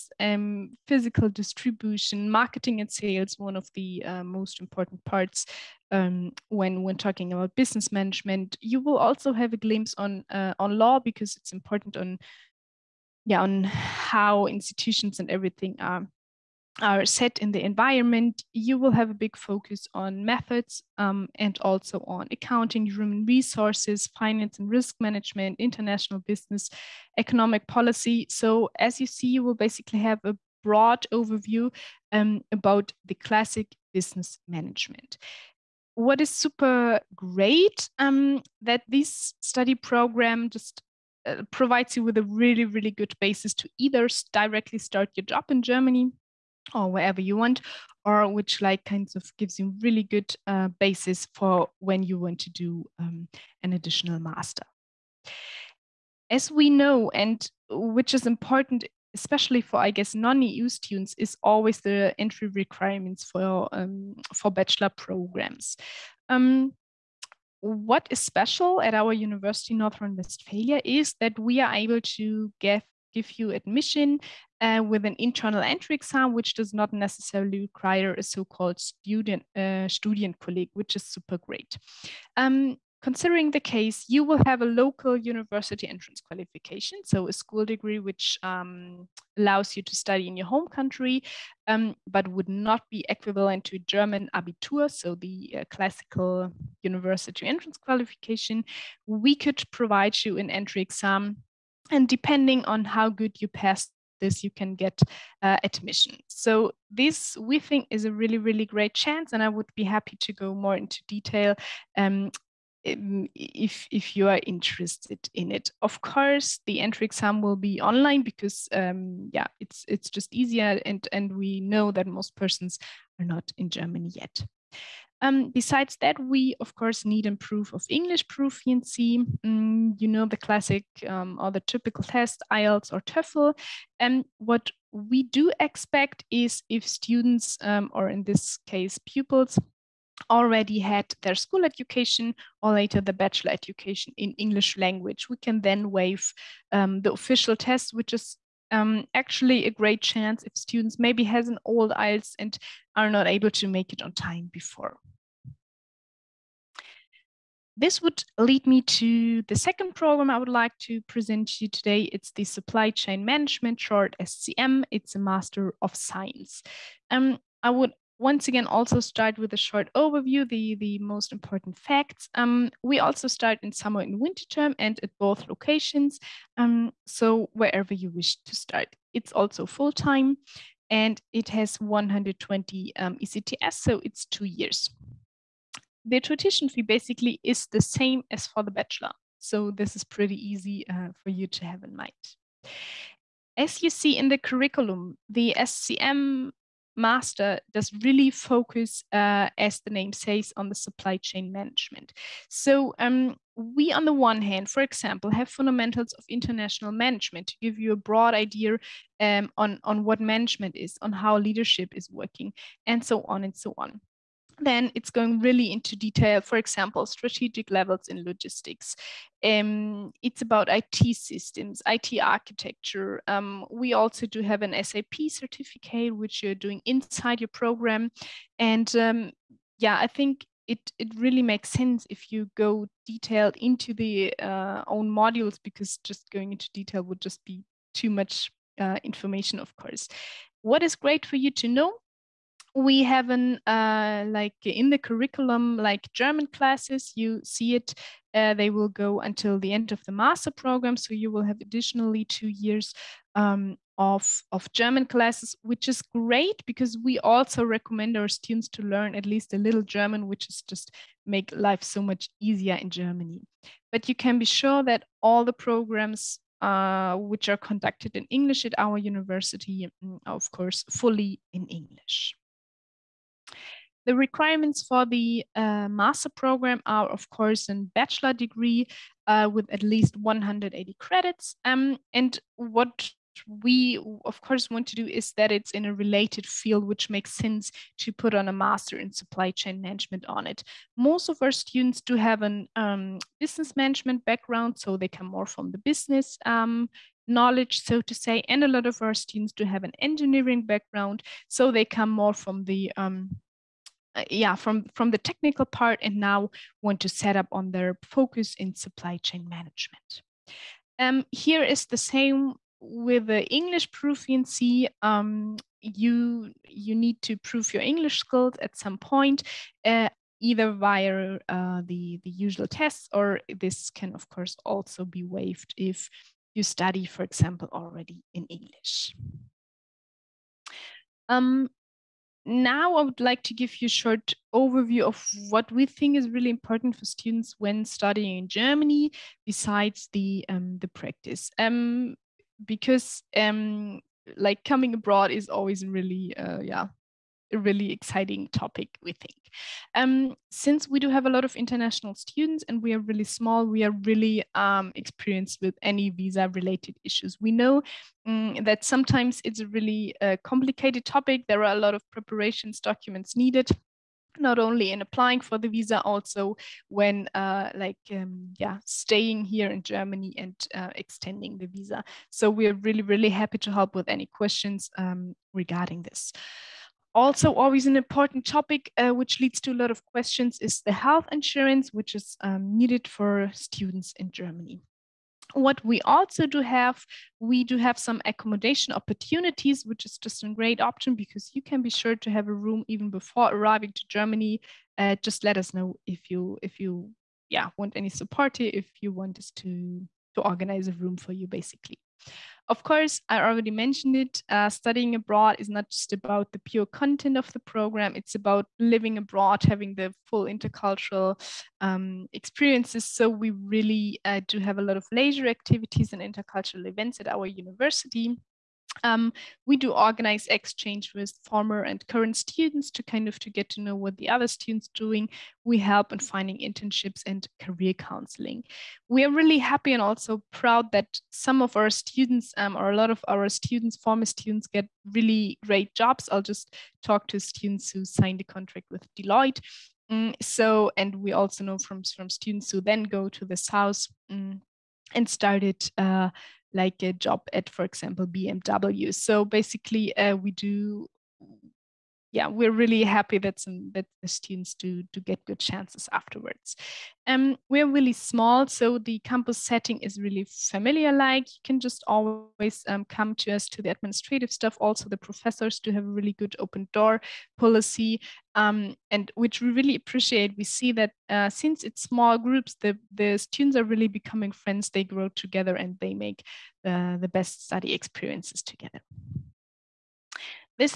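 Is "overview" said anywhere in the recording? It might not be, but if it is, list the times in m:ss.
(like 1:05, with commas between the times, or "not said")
0:31, 2:49, 5:34.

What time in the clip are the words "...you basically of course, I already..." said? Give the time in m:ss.
6:41.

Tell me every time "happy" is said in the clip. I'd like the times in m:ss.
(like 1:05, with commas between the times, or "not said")
1:49, 6:13, 7:09, 7:33.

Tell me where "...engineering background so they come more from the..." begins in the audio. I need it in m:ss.
4:59.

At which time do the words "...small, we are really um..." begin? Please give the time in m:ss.
5:53.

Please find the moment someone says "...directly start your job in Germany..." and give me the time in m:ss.
0:44.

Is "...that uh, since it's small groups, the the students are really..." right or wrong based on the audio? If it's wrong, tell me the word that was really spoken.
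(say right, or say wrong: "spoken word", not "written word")
right.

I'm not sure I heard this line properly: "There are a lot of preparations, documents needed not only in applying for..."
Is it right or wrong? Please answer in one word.
right.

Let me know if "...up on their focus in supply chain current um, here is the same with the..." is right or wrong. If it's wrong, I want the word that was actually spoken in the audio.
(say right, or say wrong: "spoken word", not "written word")
wrong: "management", not "current".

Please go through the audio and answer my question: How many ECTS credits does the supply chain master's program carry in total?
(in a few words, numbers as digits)
120.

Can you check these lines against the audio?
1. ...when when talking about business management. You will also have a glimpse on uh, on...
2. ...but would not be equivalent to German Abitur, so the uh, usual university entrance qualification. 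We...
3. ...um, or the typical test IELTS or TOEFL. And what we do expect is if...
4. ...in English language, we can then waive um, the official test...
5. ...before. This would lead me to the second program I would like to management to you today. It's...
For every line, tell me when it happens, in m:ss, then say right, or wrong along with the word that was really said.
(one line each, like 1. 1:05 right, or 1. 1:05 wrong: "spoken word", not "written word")
1. 0:06 right
2. 1:32 wrong: "classical", not "usual"
3. 2:11 right
4. 2:24 right
5. 2:34 wrong: "present", not "management".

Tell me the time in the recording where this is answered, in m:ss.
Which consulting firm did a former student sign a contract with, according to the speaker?
7:19.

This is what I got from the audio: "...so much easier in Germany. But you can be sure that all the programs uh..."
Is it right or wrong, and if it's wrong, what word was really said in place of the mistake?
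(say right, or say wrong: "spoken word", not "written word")
right.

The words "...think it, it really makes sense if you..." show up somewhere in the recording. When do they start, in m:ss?
3:50.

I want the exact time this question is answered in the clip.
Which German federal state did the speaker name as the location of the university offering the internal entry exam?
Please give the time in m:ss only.
1:09.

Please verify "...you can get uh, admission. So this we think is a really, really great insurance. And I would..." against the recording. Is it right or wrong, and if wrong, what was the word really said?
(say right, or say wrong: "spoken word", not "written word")
wrong: "chance", not "insurance".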